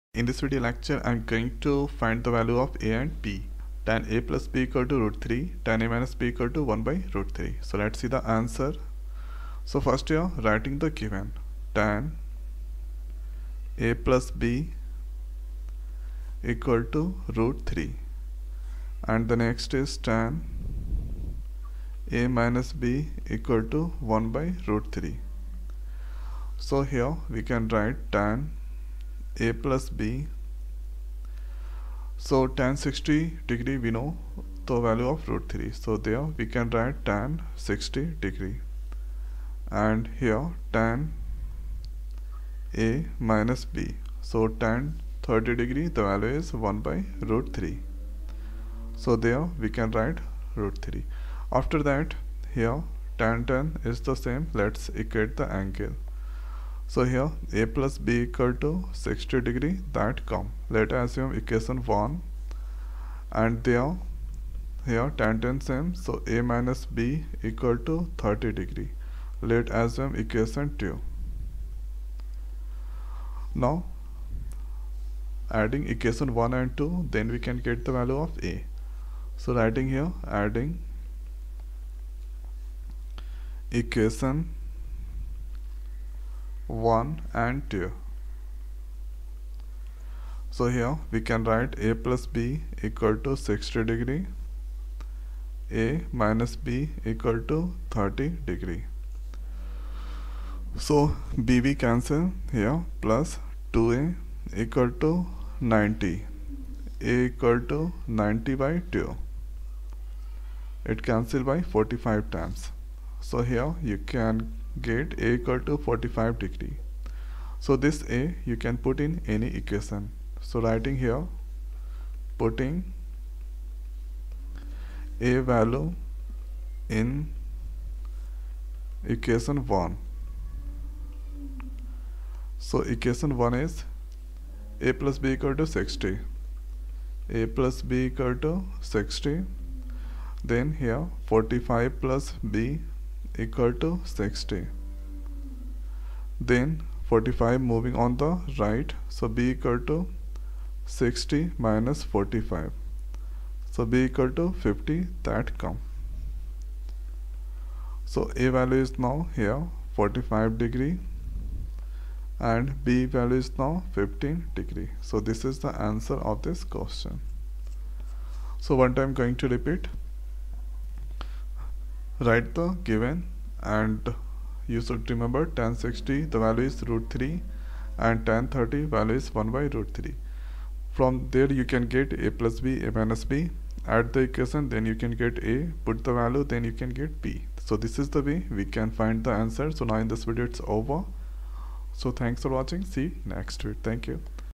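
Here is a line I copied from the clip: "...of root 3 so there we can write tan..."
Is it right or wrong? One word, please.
right.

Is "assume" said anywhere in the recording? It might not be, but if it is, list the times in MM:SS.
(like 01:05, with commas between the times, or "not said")
01:01, 01:09.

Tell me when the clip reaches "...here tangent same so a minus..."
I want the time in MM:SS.
01:04.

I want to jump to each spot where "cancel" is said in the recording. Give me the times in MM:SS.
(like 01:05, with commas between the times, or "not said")
01:41, 01:51.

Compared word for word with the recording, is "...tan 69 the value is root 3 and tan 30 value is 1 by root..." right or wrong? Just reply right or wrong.
wrong.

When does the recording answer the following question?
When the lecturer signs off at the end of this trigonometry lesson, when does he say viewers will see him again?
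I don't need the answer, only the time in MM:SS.
03:13.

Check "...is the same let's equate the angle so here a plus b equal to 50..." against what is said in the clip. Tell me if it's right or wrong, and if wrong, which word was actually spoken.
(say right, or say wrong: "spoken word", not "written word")
wrong: "60", not "50".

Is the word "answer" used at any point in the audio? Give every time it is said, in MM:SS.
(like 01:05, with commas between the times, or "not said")
00:08, 02:45, 03:09.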